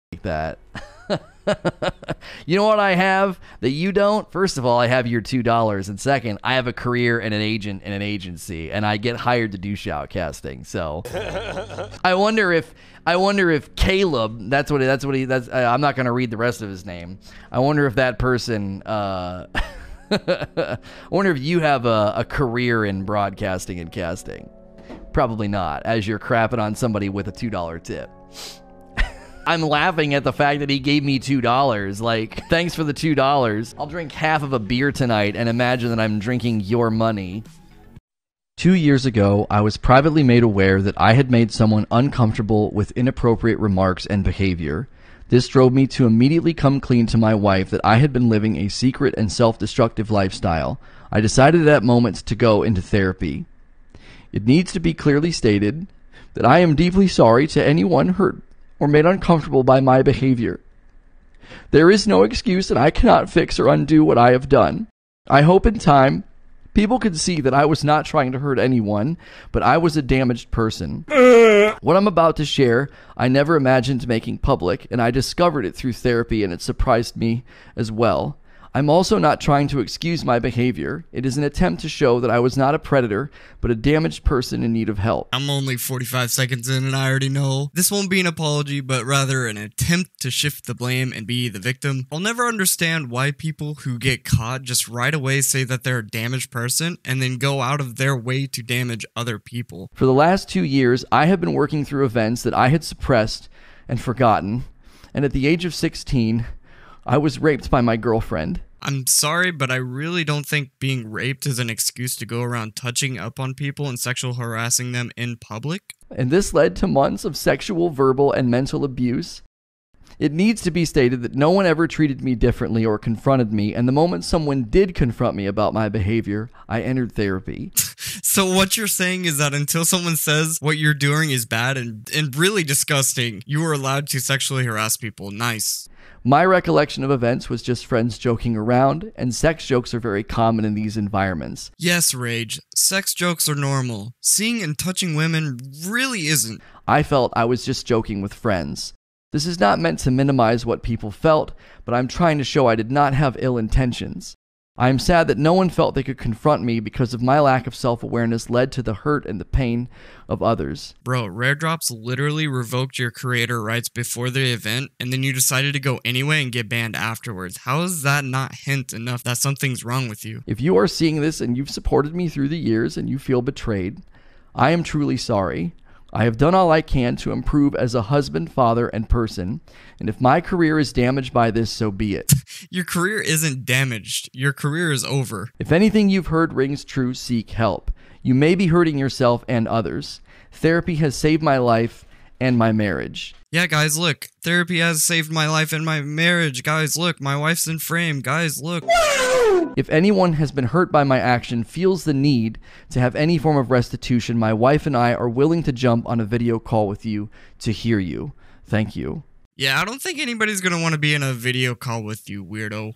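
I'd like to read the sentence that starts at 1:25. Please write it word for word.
I'm only 45 seconds in and I already know.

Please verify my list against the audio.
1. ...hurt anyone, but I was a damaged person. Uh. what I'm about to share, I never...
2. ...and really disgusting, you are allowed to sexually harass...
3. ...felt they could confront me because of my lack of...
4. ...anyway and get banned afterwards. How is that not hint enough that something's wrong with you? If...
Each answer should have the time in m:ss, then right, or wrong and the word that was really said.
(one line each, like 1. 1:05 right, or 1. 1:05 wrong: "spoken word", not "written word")
1. 1:08 right
2. 2:12 right
3. 2:35 right
4. 2:46 right.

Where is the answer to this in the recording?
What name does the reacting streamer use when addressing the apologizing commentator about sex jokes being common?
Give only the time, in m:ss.
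2:22.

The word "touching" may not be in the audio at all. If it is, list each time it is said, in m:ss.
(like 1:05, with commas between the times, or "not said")
1:52, 2:24.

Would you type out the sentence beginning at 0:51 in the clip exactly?
I decided at that moment to go into therapy.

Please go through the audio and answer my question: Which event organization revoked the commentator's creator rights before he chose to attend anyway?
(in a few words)
Rare Drops.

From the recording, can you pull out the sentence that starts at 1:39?
For the last two years, I have been working through events that I had suppressed and forgotten.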